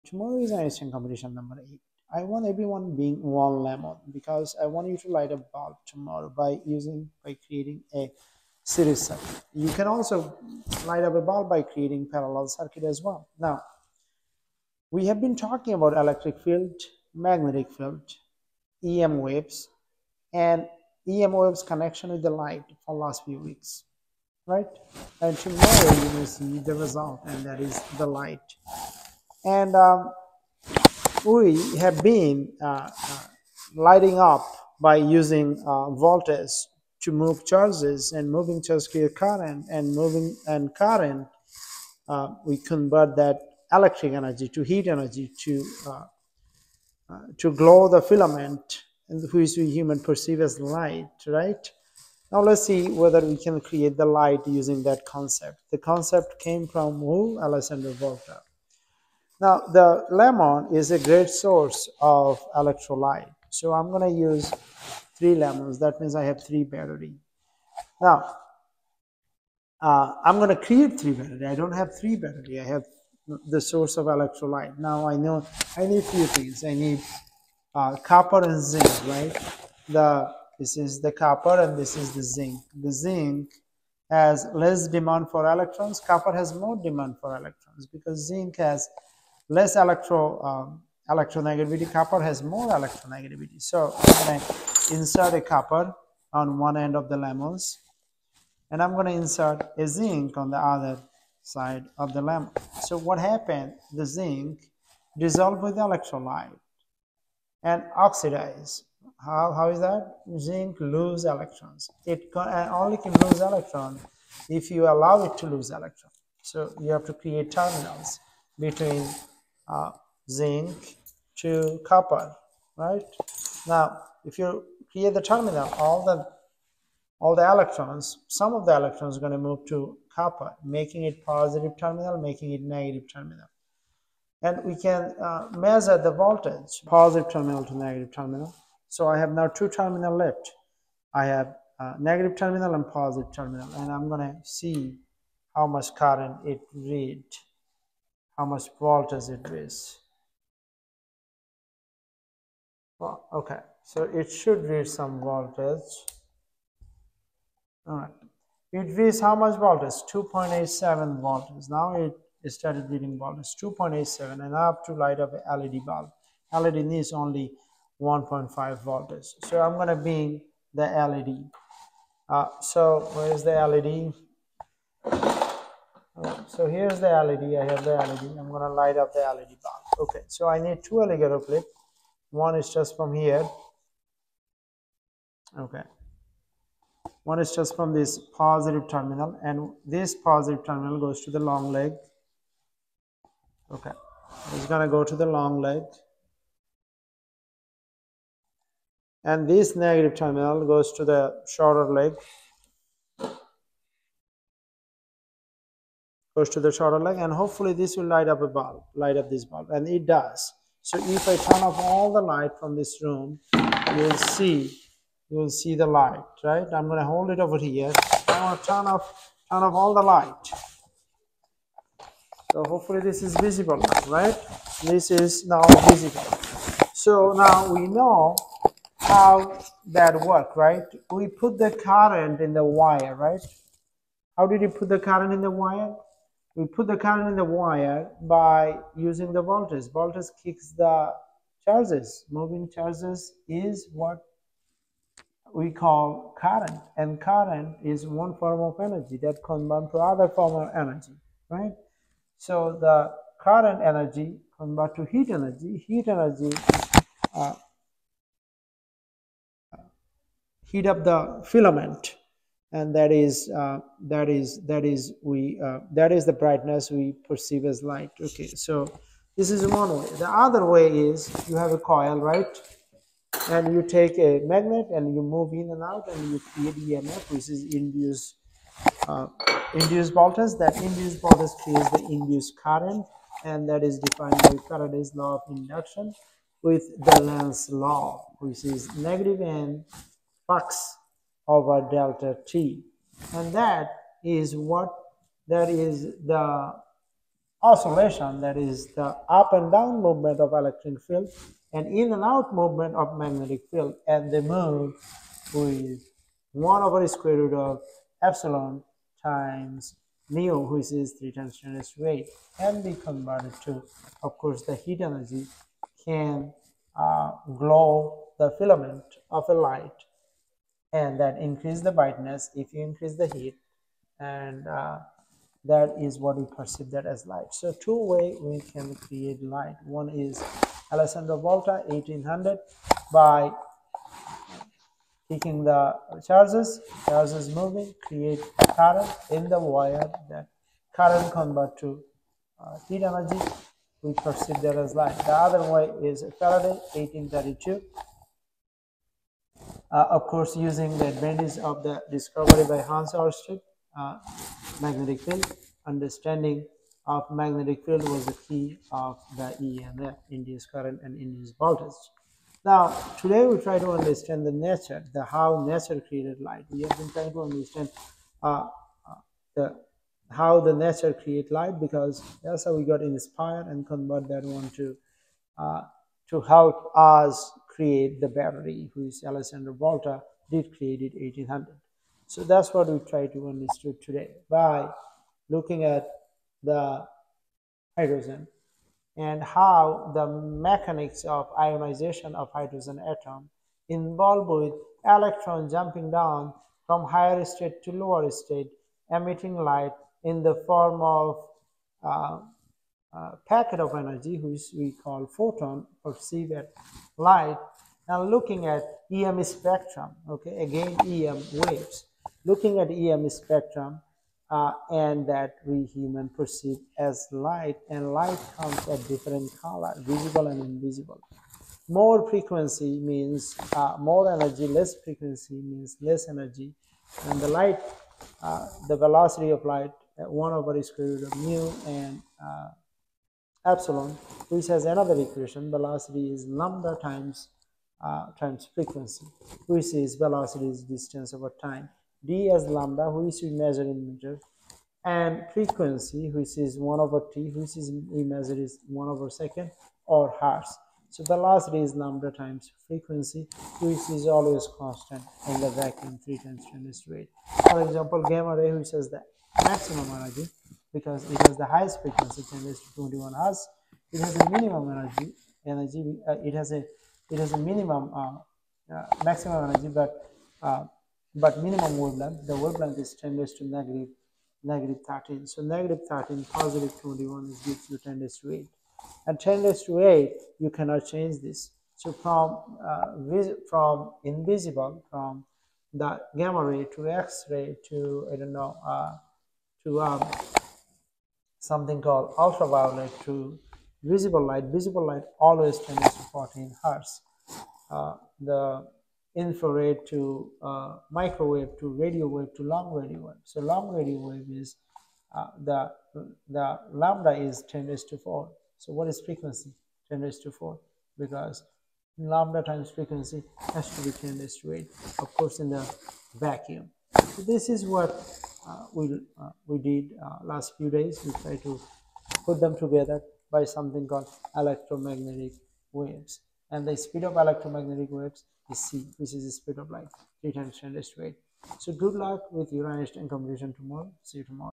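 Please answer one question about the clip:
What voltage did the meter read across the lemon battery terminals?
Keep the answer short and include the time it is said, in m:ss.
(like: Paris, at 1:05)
2.87 volts, at 2:40.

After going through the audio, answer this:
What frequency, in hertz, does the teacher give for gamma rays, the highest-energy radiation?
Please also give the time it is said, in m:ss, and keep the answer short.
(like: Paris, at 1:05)
10^21 hertz, at 7:42.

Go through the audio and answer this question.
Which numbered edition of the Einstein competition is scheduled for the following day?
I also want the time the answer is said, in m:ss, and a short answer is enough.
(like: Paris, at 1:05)
8, at 0:01.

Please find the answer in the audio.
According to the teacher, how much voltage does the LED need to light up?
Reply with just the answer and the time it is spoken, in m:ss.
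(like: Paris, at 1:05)
1.5, at 2:48.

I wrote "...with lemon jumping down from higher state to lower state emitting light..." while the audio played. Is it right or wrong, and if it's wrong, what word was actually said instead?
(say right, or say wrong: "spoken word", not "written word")
wrong: "electron", not "lemon".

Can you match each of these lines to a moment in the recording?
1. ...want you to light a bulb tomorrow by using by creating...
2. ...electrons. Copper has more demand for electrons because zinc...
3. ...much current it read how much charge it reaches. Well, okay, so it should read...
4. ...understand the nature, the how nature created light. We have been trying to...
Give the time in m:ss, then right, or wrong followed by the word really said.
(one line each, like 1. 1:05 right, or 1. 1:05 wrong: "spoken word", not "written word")
1. 0:04 right
2. 1:25 right
3. 2:25 wrong: "voltage", not "charge"
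4. 6:03 right.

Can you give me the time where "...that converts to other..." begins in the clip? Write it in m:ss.
4:09.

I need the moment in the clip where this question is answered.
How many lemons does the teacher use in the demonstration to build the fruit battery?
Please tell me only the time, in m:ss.
1:05.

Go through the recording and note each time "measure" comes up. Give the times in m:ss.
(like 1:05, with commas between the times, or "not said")
2:15, 7:23, 7:28.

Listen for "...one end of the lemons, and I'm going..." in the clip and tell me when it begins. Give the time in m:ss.
1:36.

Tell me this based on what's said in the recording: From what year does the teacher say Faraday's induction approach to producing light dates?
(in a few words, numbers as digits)
1832.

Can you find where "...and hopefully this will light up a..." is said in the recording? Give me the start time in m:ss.
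3:27.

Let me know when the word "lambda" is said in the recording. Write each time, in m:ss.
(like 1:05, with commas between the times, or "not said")
7:16, 7:22, 7:31, 8:26, 8:32.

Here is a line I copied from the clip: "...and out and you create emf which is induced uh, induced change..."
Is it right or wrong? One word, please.
wrong.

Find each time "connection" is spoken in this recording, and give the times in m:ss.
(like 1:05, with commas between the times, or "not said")
0:21.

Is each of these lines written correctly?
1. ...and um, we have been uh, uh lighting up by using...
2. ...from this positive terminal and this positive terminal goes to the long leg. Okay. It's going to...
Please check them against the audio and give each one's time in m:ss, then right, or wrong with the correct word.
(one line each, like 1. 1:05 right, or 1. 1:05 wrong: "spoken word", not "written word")
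1. 0:29 right
2. 3:07 right.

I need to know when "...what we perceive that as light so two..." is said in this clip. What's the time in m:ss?
5:26.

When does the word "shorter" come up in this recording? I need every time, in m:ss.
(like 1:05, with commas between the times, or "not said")
3:21, 3:26.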